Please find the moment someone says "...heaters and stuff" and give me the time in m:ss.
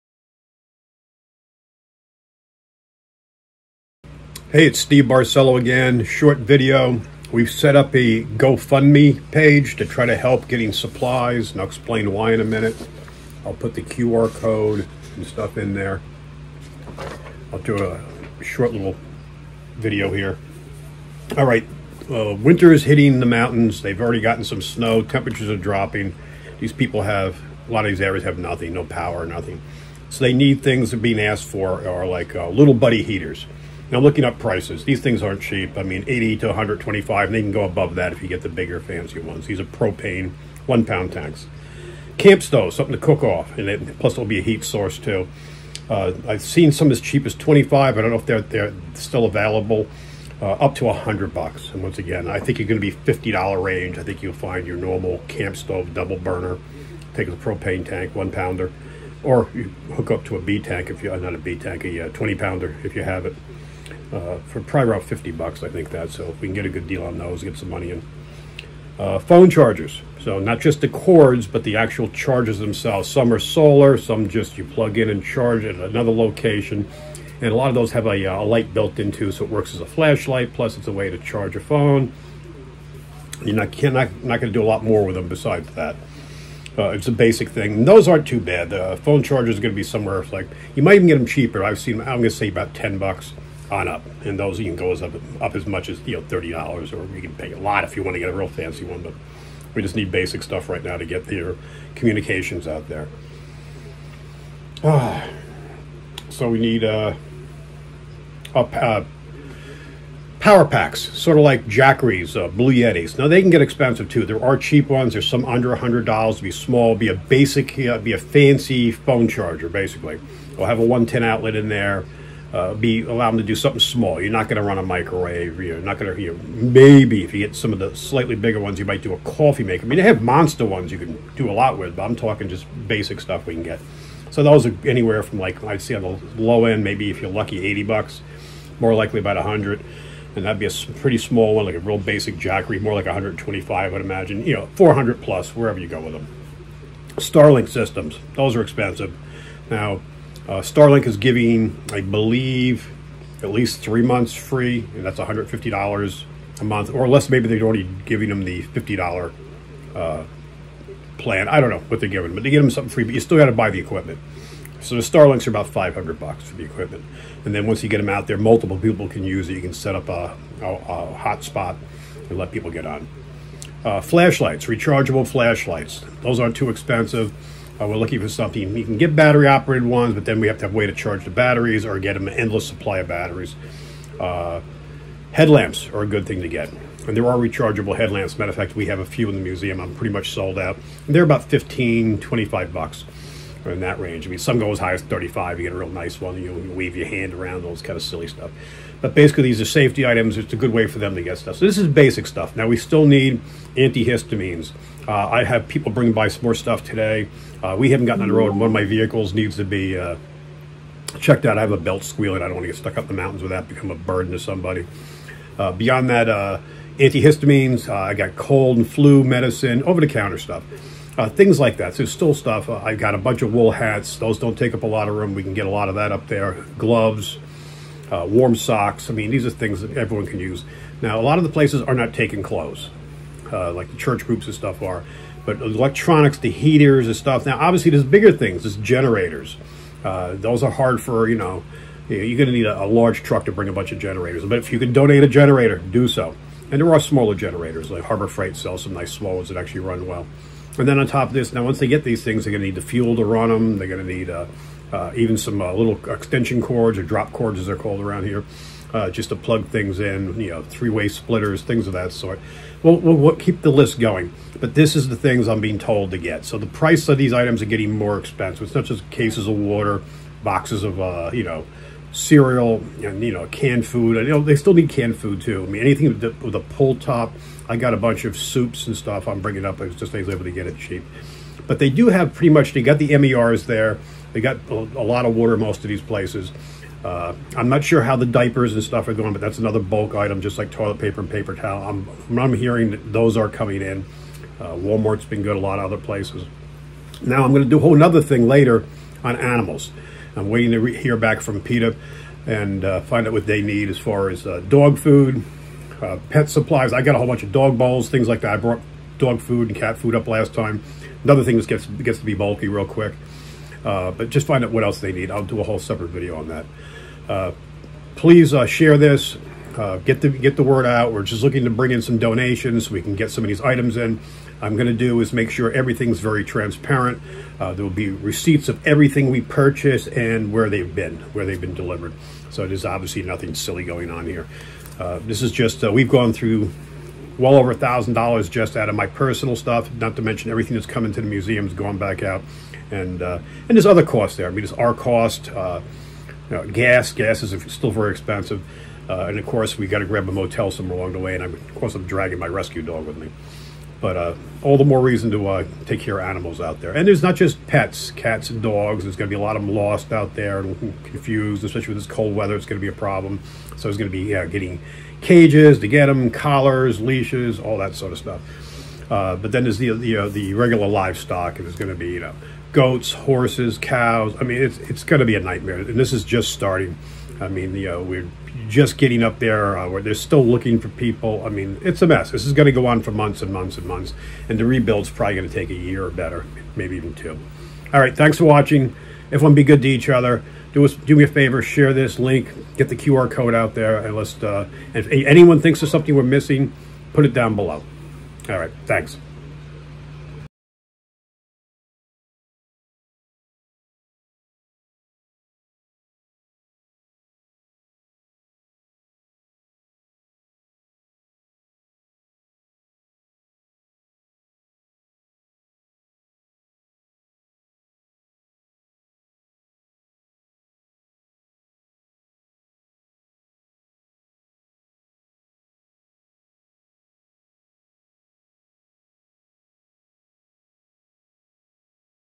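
3:56.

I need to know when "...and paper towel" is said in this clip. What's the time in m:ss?
4:51.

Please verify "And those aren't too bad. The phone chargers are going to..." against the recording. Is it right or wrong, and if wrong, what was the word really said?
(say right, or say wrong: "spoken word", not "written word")
right.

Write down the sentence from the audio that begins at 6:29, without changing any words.
Everyone be good to each other.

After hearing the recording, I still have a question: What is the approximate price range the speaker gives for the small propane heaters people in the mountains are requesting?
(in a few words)
80 to 125.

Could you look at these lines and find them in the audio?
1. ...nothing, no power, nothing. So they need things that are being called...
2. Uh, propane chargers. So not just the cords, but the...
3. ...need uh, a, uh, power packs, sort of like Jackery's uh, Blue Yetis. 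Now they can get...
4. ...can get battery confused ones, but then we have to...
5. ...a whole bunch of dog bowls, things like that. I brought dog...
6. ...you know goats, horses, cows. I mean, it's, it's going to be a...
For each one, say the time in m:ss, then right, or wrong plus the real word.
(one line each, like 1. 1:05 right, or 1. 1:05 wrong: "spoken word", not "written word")
1. 0:28 wrong: "asked", not "called"
2. 1:08 wrong: "phone", not "propane"
3. 1:46 right
4. 2:58 wrong: "operated", not "confused"
5. 5:07 right
6. 6:12 right.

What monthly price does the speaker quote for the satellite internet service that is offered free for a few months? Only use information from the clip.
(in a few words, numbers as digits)
$150.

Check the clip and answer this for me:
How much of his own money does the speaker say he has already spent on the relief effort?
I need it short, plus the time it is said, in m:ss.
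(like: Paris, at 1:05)
over $1,000, at 5:37.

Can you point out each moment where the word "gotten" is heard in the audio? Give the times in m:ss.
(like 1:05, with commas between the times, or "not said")
0:24, 3:28.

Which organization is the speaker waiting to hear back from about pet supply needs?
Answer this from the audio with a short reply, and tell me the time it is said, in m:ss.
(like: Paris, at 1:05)
PETA, at 5:01.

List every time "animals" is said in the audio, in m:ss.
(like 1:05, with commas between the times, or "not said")
4:59, 5:56.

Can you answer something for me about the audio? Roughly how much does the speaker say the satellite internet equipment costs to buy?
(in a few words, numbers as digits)
$500.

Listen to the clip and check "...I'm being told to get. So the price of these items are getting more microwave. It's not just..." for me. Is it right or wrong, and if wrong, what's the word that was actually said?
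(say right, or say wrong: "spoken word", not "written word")
wrong: "expensive", not "microwave".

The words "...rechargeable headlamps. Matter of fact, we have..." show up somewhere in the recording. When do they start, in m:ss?
3:07.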